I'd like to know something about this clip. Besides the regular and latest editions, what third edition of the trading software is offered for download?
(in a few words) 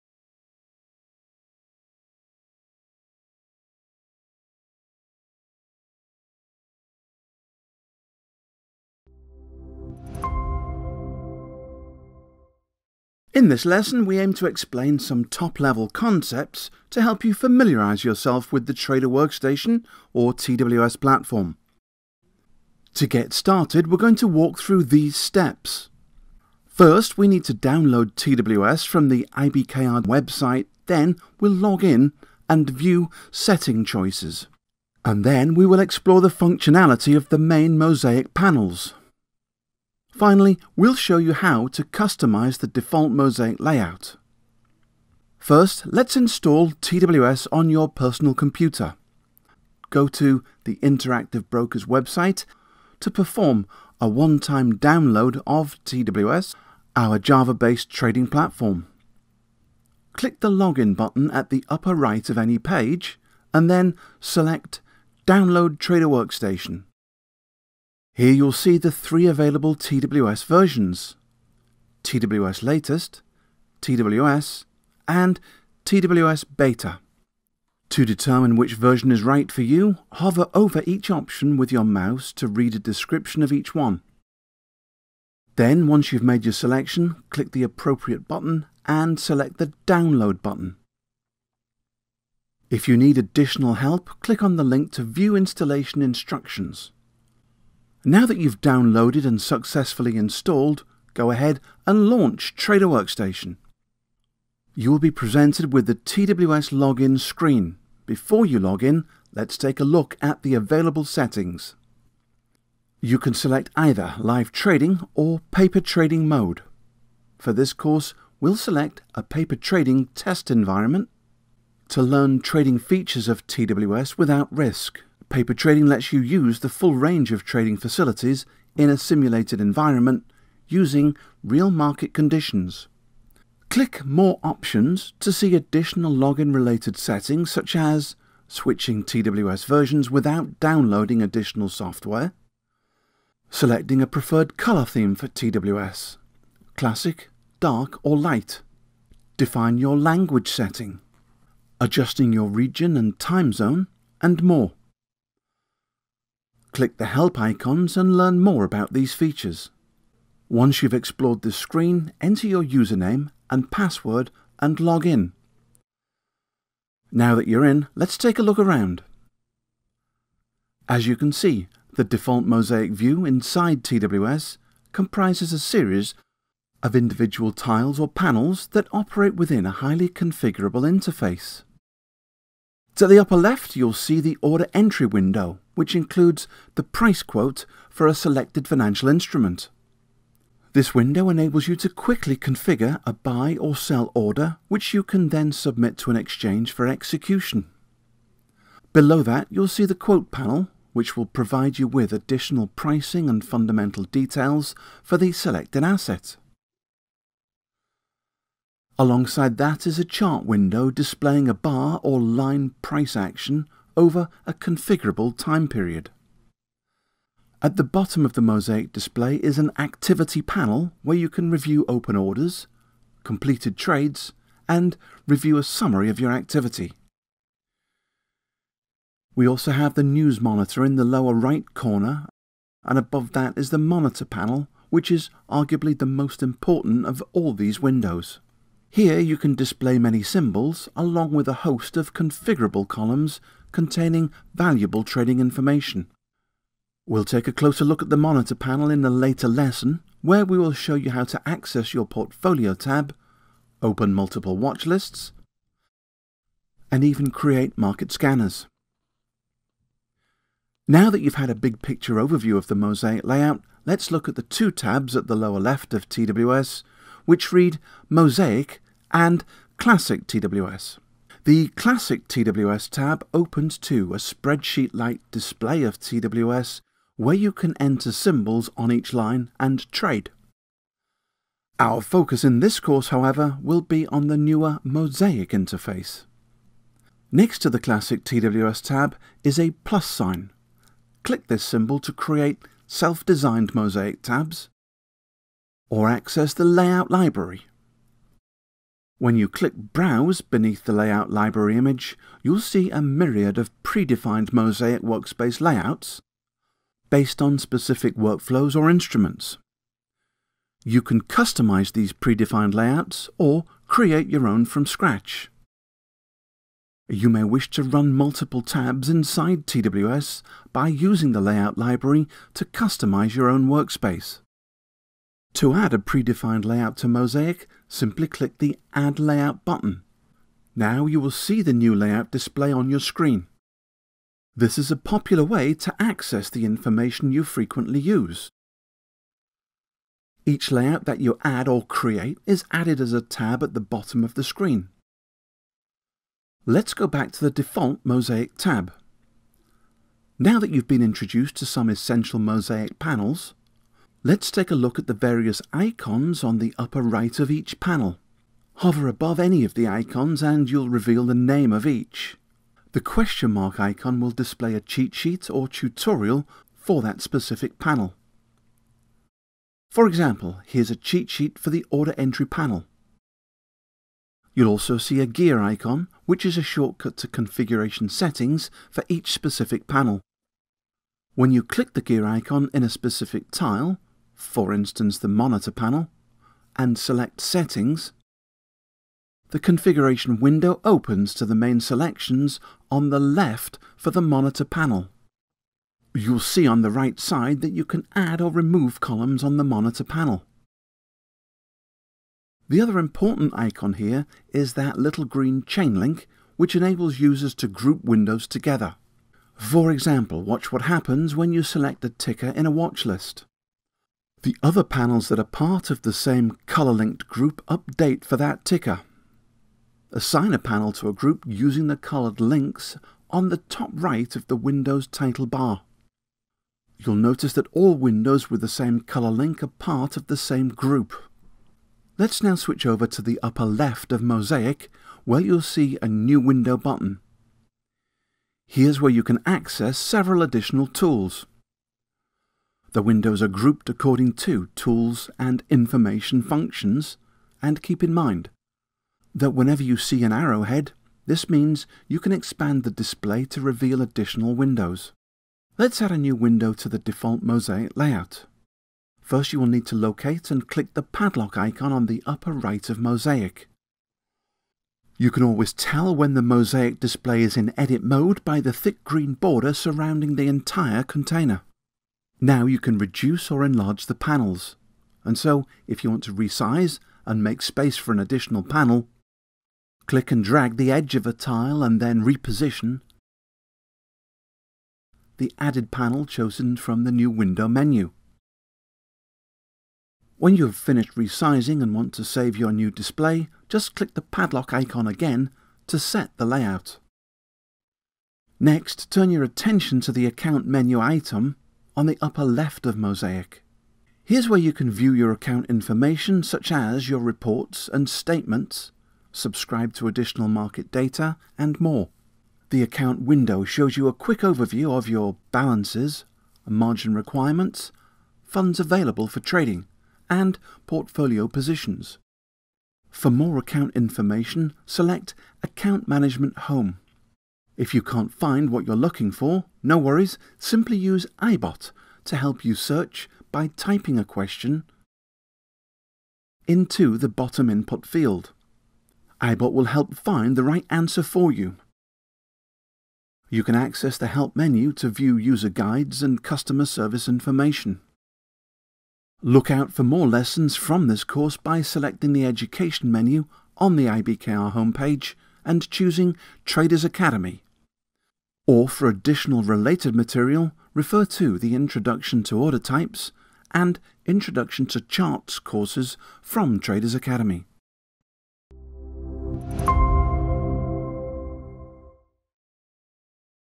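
TWS Beta.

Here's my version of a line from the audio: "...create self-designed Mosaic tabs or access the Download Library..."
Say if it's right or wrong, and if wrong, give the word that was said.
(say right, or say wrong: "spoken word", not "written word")
wrong: "Layout", not "Download".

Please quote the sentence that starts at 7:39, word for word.
First you will need to locate and click the padlock icon on the upper right of mosaic.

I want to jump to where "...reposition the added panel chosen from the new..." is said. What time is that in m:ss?
8:02.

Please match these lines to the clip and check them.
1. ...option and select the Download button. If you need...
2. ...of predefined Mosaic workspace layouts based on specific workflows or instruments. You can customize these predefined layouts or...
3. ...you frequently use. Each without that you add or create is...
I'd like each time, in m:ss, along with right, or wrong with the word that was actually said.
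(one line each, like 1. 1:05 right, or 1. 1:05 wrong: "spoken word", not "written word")
1. 1:28 wrong: "button", not "option"
2. 5:03 right
3. 5:37 wrong: "layout", not "without".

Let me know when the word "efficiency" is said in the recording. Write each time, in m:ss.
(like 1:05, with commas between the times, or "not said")
not said.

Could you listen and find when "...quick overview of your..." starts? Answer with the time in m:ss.
8:34.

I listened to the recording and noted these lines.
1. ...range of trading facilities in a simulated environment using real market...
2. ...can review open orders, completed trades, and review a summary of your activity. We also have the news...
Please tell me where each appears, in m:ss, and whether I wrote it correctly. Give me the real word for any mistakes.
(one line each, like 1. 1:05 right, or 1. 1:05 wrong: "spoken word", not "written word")
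1. 2:06 right
2. 3:41 right.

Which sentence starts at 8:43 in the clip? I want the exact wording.
For more account information, select Account Management Home.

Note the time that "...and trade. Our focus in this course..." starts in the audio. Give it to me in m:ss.
4:39.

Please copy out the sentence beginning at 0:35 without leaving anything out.
And then we will explore the functionality of the main mosaic panels.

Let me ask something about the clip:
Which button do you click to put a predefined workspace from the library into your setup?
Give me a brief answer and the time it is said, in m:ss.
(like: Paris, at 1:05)
Add Layout, at 5:28.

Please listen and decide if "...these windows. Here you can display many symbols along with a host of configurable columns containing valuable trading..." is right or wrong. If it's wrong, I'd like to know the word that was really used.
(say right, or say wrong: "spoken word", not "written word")
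right.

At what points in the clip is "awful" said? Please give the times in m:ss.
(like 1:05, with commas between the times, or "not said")
not said.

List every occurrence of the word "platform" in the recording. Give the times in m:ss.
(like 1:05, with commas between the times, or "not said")
0:20, 0:58.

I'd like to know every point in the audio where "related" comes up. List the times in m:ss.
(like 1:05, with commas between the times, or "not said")
2:16, 9:19.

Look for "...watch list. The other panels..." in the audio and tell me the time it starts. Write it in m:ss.
6:52.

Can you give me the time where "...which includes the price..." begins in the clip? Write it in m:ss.
3:05.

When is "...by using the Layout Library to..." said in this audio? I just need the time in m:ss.
5:20.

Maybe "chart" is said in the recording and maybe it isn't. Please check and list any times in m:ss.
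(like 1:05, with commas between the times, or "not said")
3:30, 9:25.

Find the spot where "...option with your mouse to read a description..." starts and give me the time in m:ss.
1:21.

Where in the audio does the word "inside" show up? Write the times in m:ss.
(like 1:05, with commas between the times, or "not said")
2:53, 5:19.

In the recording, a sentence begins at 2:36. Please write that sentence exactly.
Click the help icons and learn more about these features.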